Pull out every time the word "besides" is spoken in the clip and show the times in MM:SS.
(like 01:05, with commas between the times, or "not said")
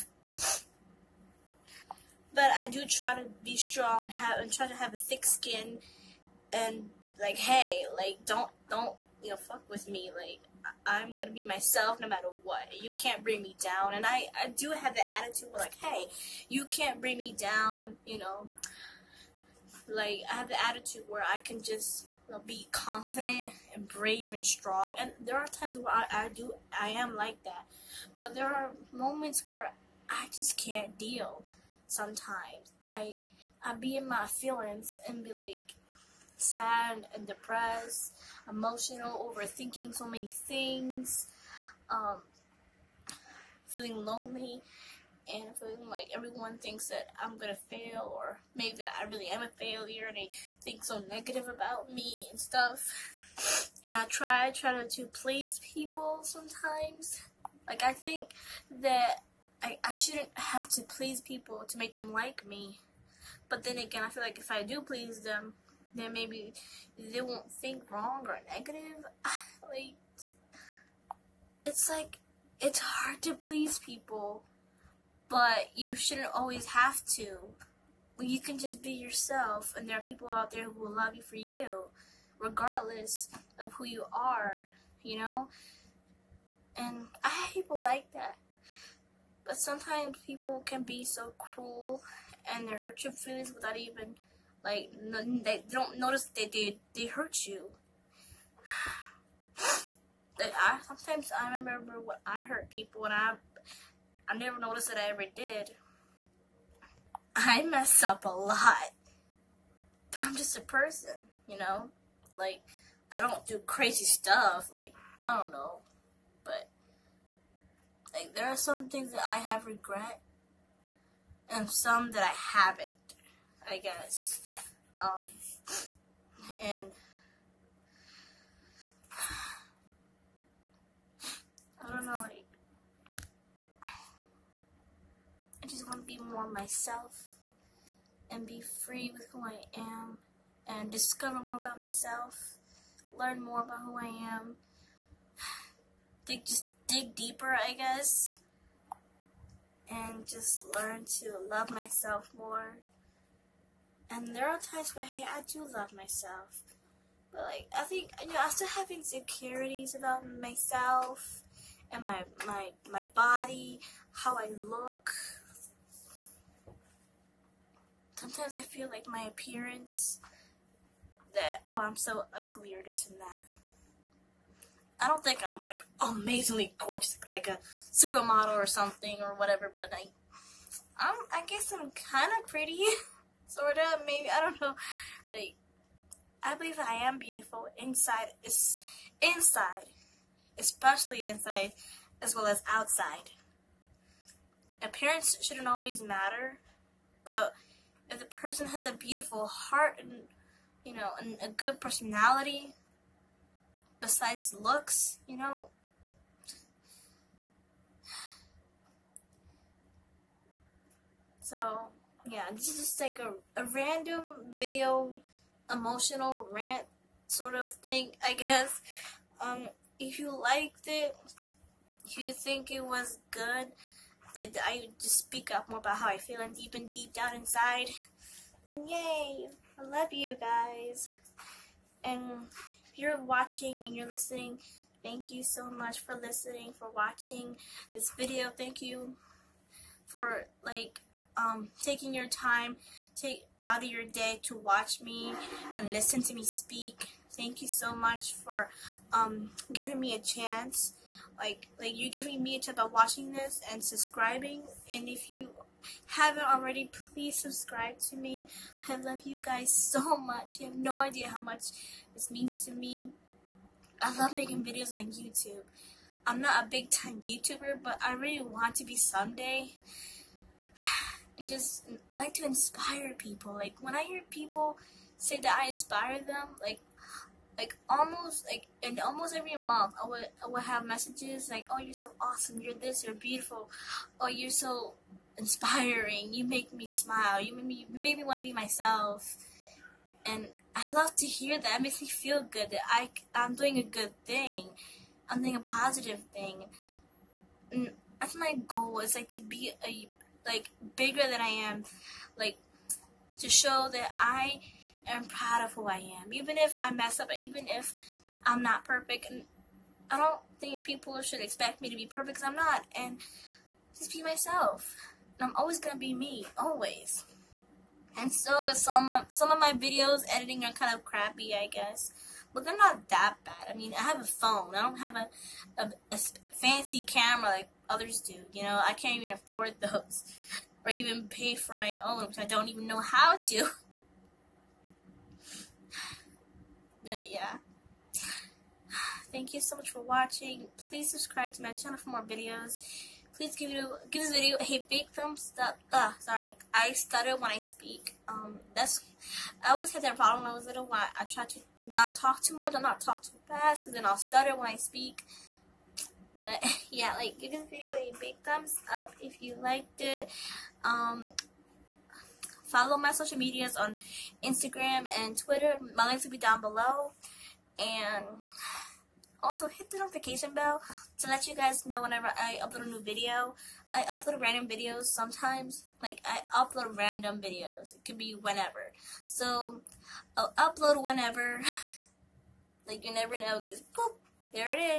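03:23.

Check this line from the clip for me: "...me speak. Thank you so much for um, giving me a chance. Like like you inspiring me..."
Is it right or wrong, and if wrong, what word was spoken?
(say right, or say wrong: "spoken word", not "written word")
wrong: "giving", not "inspiring".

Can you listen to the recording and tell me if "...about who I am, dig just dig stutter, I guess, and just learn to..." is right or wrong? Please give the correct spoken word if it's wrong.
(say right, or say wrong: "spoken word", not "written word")
wrong: "deeper", not "stutter".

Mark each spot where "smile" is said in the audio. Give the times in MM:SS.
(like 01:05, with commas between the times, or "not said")
04:46.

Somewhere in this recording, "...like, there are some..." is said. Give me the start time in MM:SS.
01:58.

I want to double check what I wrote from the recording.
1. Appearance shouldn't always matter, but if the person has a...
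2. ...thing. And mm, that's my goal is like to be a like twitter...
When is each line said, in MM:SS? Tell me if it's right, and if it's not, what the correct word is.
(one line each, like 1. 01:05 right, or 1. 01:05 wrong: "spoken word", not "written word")
1. 03:14 right
2. 04:56 wrong: "bigger", not "twitter".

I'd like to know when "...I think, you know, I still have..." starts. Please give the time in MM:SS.
02:37.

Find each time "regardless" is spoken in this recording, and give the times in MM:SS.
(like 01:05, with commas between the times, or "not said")
01:22.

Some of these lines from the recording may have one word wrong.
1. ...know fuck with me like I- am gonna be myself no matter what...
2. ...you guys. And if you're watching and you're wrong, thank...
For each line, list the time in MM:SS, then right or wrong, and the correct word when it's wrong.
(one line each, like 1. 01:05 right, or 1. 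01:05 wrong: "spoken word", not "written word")
1. 00:09 right
2. 03:50 wrong: "listening", not "wrong".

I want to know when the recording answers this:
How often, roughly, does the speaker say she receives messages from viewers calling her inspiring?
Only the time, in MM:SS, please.
04:38.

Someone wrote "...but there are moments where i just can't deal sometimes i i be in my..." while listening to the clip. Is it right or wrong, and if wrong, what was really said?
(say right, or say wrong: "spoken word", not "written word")
right.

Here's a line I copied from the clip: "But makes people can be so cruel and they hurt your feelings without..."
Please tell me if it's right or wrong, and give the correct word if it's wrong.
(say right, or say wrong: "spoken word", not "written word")
wrong: "sometimes", not "makes".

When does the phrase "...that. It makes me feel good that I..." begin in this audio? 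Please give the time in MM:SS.
04:51.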